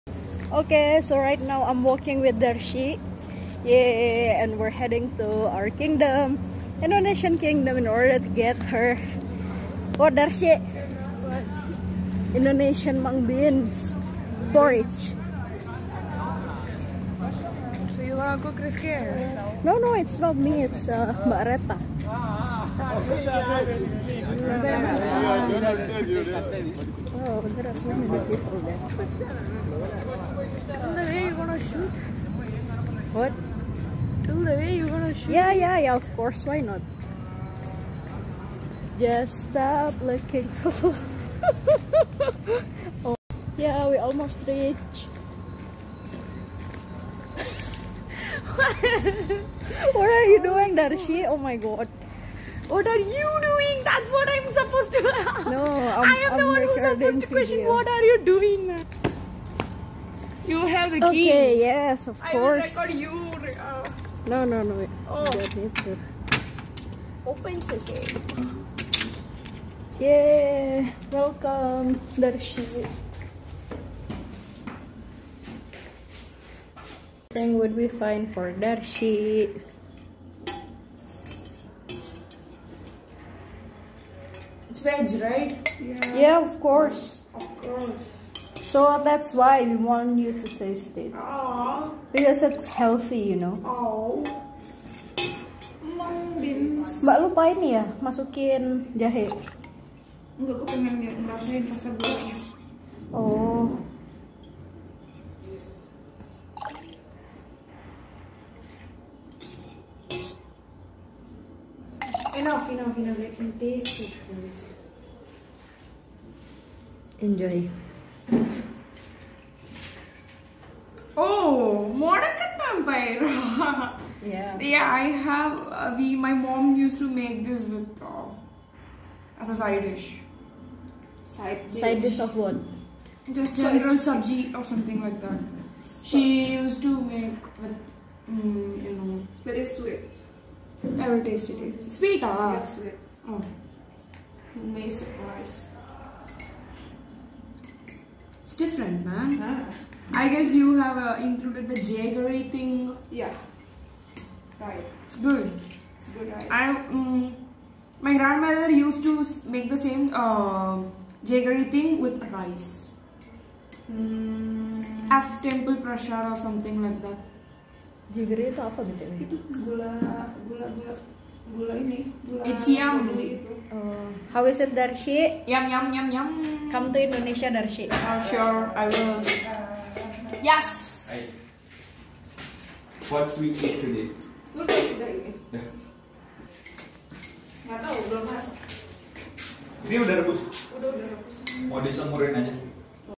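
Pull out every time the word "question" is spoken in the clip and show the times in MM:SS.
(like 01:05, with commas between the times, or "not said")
00:57.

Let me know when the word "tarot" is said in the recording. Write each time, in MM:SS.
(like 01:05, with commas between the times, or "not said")
not said.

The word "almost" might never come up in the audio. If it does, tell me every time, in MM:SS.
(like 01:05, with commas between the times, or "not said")
00:43.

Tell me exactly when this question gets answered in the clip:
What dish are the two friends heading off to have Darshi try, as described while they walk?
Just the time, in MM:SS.
00:12.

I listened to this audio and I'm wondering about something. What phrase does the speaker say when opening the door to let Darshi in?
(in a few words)
Open sesame.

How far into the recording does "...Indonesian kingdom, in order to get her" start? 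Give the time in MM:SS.
00:06.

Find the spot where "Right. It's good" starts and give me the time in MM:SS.
02:34.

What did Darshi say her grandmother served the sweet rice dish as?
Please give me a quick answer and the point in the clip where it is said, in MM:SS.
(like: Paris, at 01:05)
Temple prashad, at 02:45.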